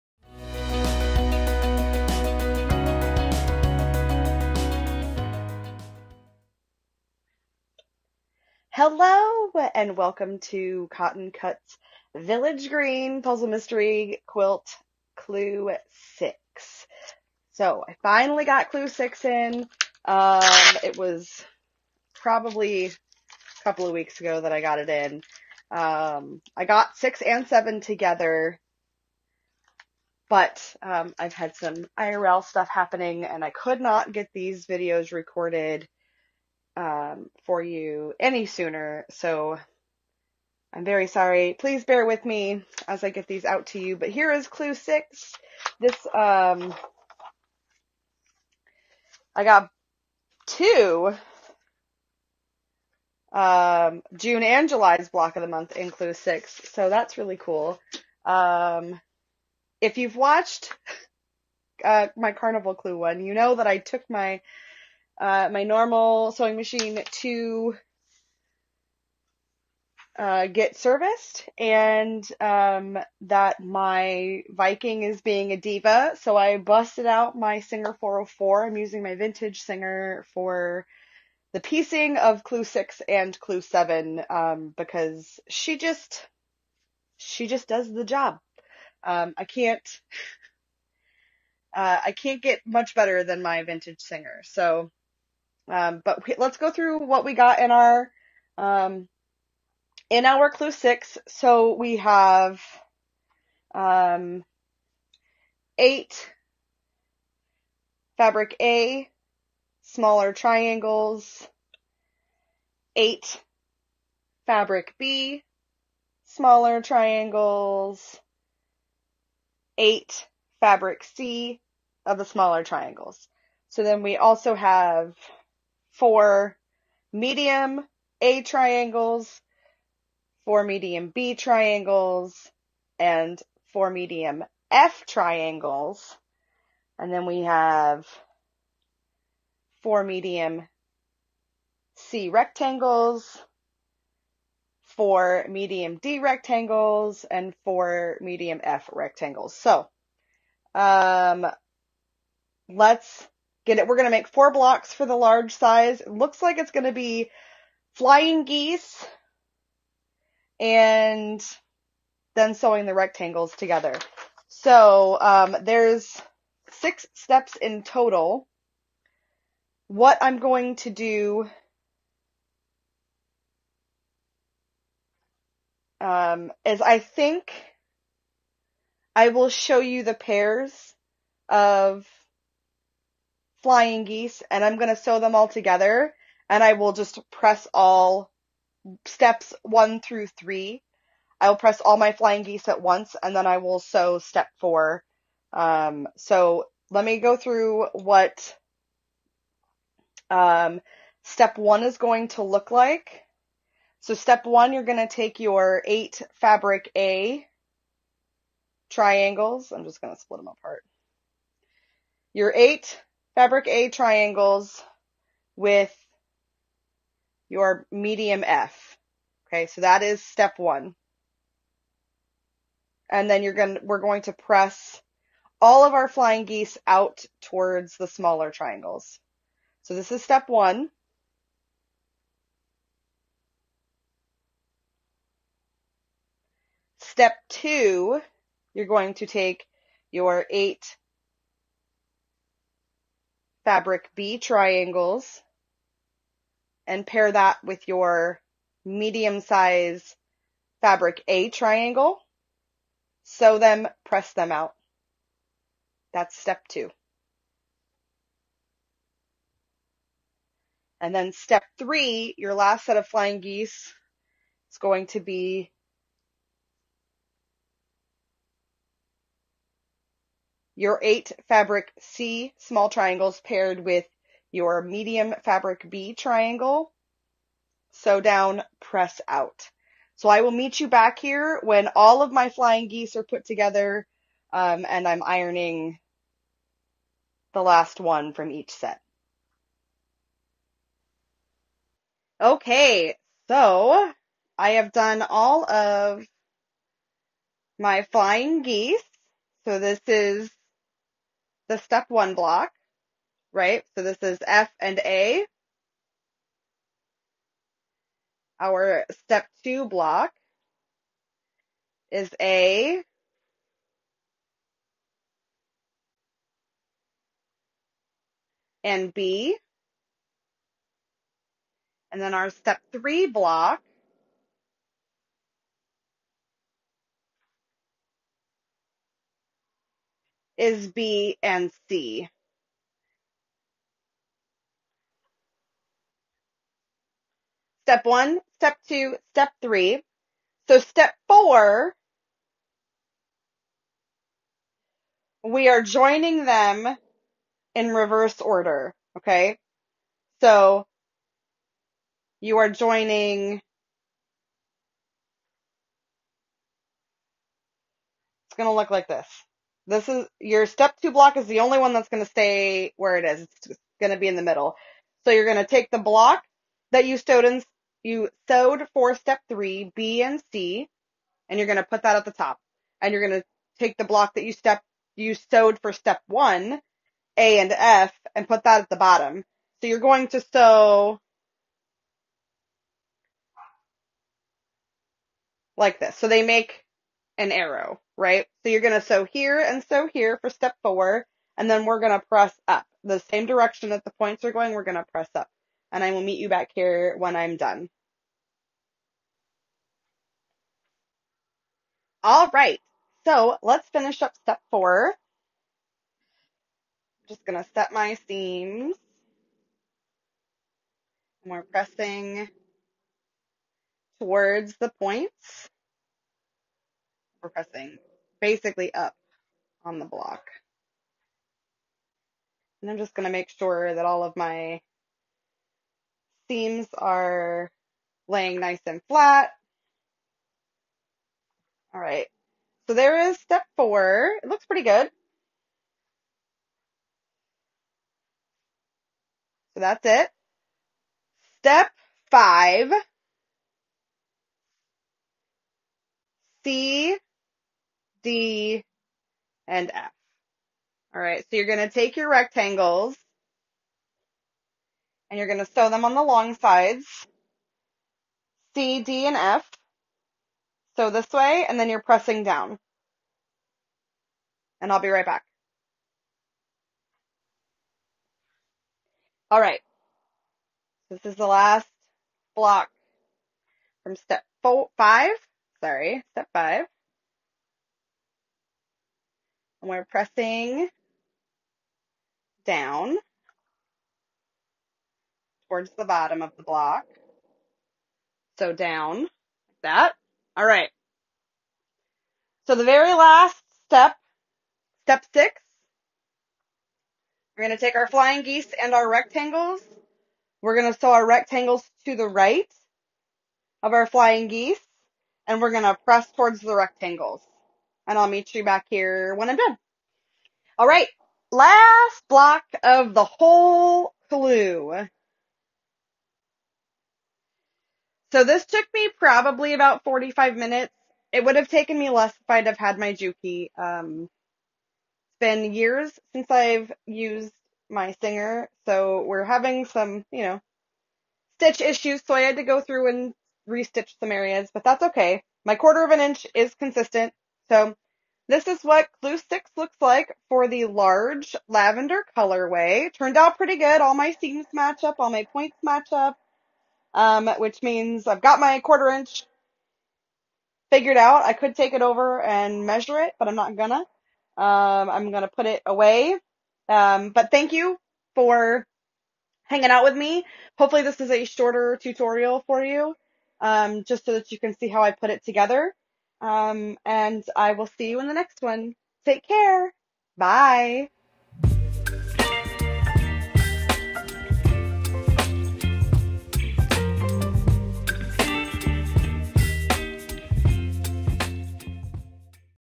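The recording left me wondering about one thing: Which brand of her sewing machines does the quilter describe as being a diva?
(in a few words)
Viking.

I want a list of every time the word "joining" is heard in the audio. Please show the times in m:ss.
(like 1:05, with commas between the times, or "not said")
5:45, 5:52.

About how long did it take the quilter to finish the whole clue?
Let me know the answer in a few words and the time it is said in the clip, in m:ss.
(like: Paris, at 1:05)
45 minutes, at 8:40.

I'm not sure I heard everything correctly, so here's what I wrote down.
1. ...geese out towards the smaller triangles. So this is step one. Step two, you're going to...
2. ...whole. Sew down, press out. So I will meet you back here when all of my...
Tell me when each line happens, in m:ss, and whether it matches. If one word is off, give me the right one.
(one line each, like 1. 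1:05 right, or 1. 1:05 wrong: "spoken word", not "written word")
1. 3:46 right
2. 4:36 wrong: "triangle", not "whole".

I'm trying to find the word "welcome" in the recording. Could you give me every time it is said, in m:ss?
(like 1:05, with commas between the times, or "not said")
0:09.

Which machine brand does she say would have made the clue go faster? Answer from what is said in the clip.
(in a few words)
Juki.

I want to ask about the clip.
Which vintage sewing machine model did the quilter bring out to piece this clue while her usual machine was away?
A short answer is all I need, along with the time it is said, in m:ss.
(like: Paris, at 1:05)
Singer 404, at 1:17.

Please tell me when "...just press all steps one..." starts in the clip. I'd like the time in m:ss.
3:06.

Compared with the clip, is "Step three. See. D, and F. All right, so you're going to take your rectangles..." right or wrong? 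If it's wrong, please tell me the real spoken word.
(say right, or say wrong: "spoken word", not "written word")
wrong: "five", not "three".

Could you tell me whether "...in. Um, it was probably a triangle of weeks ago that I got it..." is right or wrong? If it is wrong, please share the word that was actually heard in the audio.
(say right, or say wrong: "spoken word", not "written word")
wrong: "couple", not "triangle".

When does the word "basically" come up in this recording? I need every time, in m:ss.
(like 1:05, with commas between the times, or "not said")
6:58.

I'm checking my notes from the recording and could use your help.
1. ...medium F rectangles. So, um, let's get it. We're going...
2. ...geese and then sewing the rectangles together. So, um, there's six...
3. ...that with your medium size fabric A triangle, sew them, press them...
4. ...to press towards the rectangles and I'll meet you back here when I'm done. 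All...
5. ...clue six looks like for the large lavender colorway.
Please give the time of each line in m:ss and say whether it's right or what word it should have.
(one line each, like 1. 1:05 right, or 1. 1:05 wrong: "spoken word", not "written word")
1. 2:28 right
2. 2:38 right
3. 4:07 right
4. 8:25 right
5. 8:59 right.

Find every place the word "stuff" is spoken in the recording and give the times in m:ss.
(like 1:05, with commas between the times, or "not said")
0:32.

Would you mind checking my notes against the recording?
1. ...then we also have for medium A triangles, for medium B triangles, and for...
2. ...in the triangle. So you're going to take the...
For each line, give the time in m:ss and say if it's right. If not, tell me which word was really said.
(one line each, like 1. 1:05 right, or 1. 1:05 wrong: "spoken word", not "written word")
1. 2:03 right
2. 6:04 wrong: "middle", not "triangle".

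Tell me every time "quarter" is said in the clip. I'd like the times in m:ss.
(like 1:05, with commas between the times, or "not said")
8:55, 9:08.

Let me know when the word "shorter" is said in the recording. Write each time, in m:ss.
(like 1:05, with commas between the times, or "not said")
9:21.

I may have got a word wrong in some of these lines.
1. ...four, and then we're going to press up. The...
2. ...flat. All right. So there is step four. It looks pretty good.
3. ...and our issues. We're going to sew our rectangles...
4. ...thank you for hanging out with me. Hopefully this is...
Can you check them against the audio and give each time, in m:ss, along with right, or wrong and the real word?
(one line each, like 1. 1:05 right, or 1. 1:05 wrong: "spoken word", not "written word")
1. 6:30 right
2. 7:09 right
3. 8:18 wrong: "rectangles", not "issues"
4. 9:17 right.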